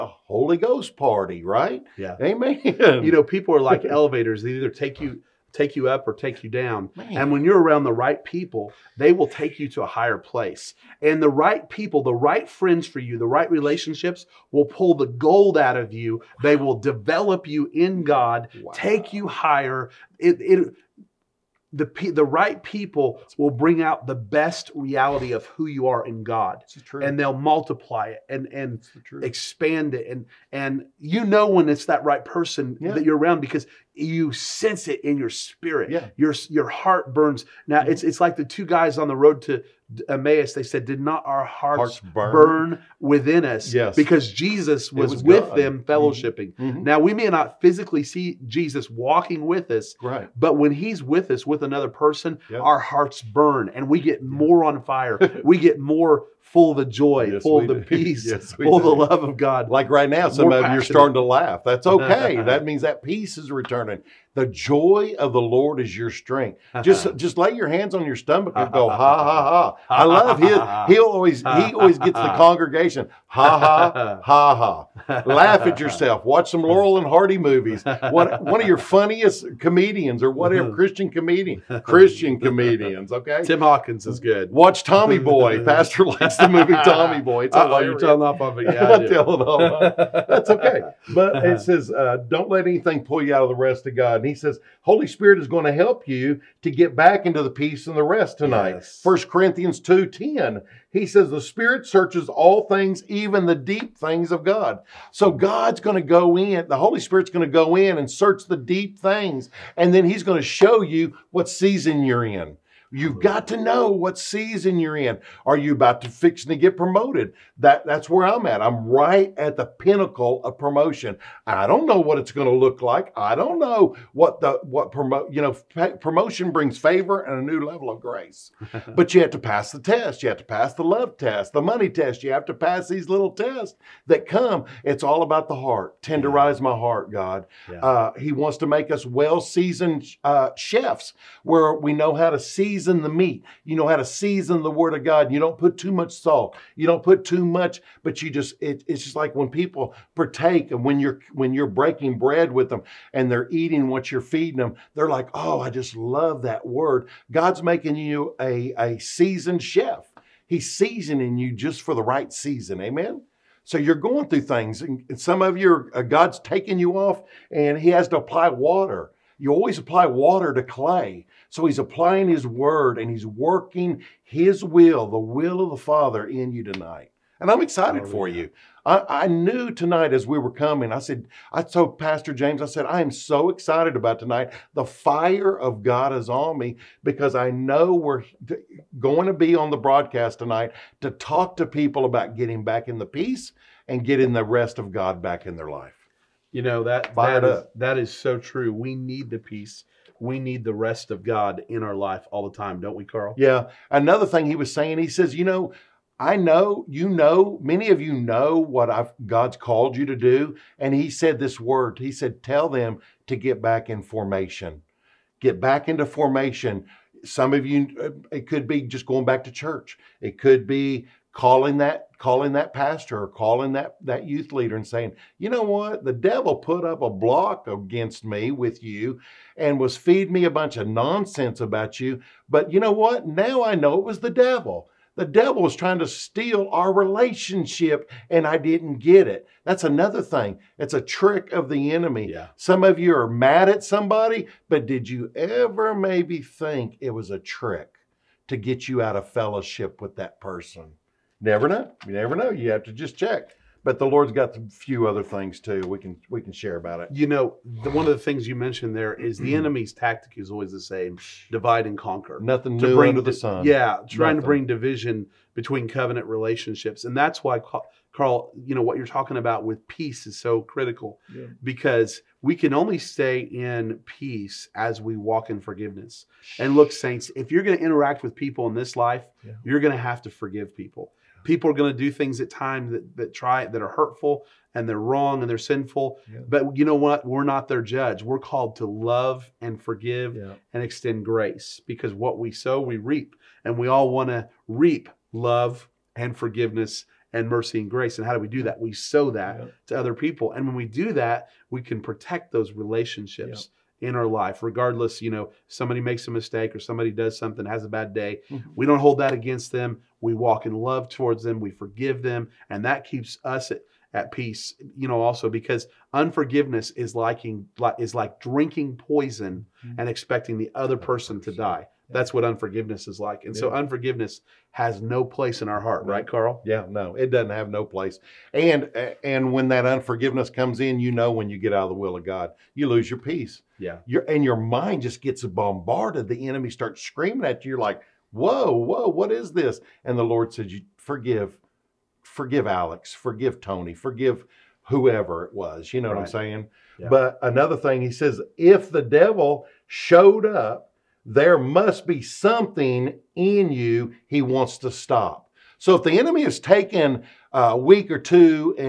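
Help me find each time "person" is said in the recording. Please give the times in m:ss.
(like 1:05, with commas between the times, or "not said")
0:32, 0:51, 4:10, 5:20.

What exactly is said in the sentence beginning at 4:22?
Nothing to new bring under the sun.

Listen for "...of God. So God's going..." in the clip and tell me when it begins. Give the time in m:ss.
1:44.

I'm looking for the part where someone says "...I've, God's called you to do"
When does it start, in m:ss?
3:28.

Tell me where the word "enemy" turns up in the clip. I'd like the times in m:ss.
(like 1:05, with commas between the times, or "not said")
4:01, 4:19, 5:36, 5:56.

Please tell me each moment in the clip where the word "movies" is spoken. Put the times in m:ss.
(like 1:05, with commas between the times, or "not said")
1:17, 1:26.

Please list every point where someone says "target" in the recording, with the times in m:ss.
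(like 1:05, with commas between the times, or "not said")
not said.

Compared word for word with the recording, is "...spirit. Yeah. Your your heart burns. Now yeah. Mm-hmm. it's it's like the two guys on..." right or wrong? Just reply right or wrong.
right.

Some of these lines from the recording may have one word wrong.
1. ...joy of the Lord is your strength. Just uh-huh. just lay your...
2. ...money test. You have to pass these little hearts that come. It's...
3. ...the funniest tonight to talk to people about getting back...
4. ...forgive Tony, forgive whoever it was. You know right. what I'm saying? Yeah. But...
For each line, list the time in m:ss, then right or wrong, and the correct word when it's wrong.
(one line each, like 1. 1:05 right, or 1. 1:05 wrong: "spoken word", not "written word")
1. 1:04 right
2. 2:11 wrong: "tests", not "hearts"
3. 3:09 wrong: "broadcast", not "funniest"
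4. 5:43 right.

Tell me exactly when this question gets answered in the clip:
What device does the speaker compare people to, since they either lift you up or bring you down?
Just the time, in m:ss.
0:03.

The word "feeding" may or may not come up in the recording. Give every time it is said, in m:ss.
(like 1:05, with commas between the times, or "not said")
2:34, 3:49.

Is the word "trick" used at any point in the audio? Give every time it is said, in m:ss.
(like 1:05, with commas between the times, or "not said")
4:01, 4:07.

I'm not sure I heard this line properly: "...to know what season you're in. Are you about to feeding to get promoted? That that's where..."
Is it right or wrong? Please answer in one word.
wrong.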